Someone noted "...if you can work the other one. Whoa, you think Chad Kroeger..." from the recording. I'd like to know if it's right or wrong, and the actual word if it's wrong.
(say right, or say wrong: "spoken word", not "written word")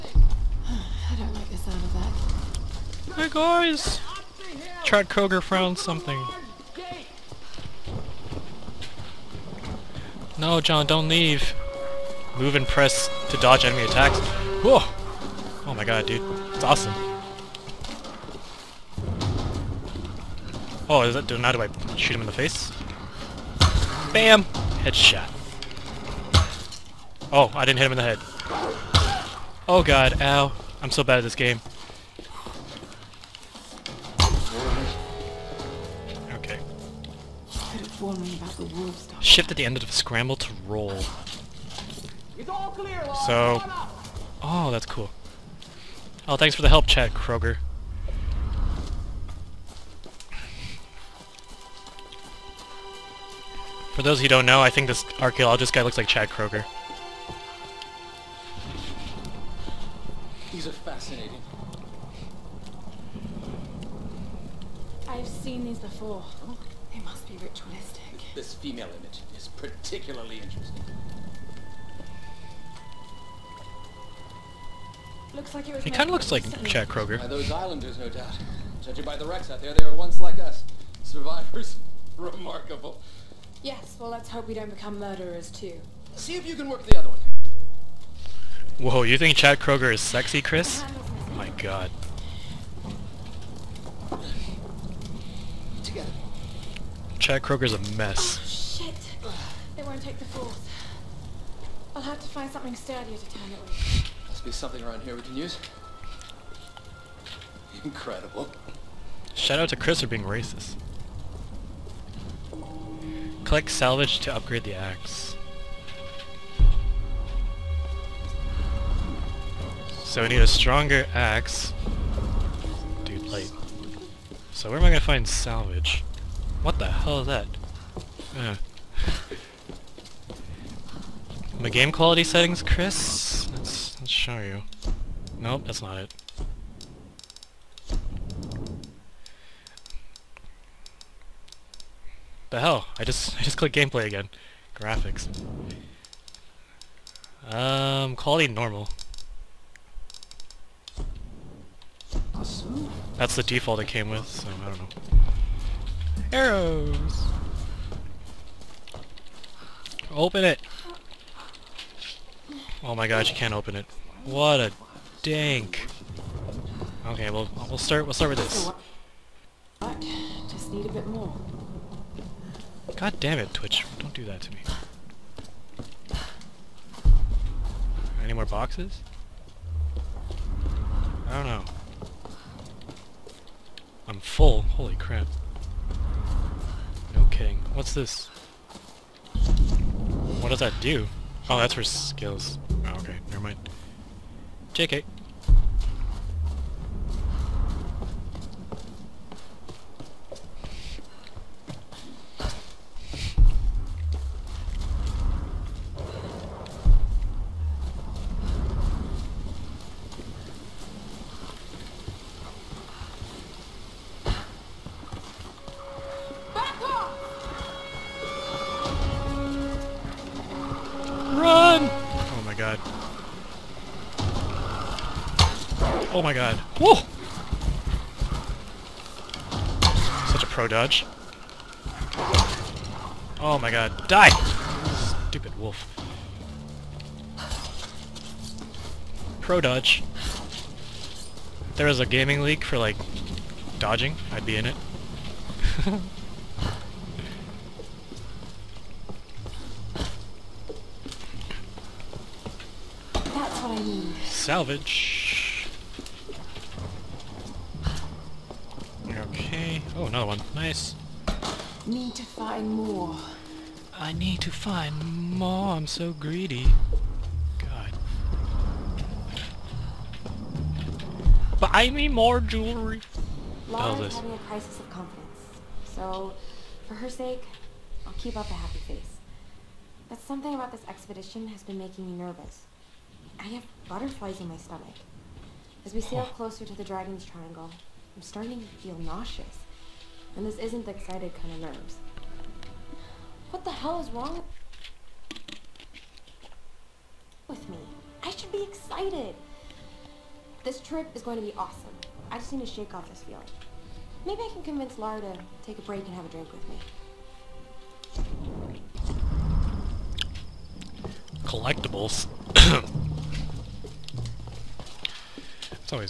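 right.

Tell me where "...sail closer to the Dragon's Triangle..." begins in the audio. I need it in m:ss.
4:46.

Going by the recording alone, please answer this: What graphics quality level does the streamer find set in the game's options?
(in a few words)
normal.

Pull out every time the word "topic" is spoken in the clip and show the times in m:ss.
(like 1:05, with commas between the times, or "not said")
not said.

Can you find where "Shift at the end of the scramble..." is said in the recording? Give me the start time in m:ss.
0:39.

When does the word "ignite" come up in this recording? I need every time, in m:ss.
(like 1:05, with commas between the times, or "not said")
not said.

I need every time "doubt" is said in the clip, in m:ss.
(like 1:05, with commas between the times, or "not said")
1:18.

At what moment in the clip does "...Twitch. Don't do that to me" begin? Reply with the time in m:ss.
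2:53.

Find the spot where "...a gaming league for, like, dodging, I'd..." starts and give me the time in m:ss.
4:01.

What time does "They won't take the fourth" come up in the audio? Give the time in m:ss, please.
1:39.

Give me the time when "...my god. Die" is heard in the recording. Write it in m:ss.
3:53.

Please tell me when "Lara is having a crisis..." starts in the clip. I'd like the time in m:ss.
4:33.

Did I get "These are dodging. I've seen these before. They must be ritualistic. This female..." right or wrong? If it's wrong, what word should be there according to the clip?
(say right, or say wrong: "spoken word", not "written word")
wrong: "fascinating", not "dodging".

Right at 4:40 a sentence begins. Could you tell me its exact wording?
But something about this expedition has been making me nervous.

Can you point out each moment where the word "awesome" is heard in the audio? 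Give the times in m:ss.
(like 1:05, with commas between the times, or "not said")
0:16, 5:01.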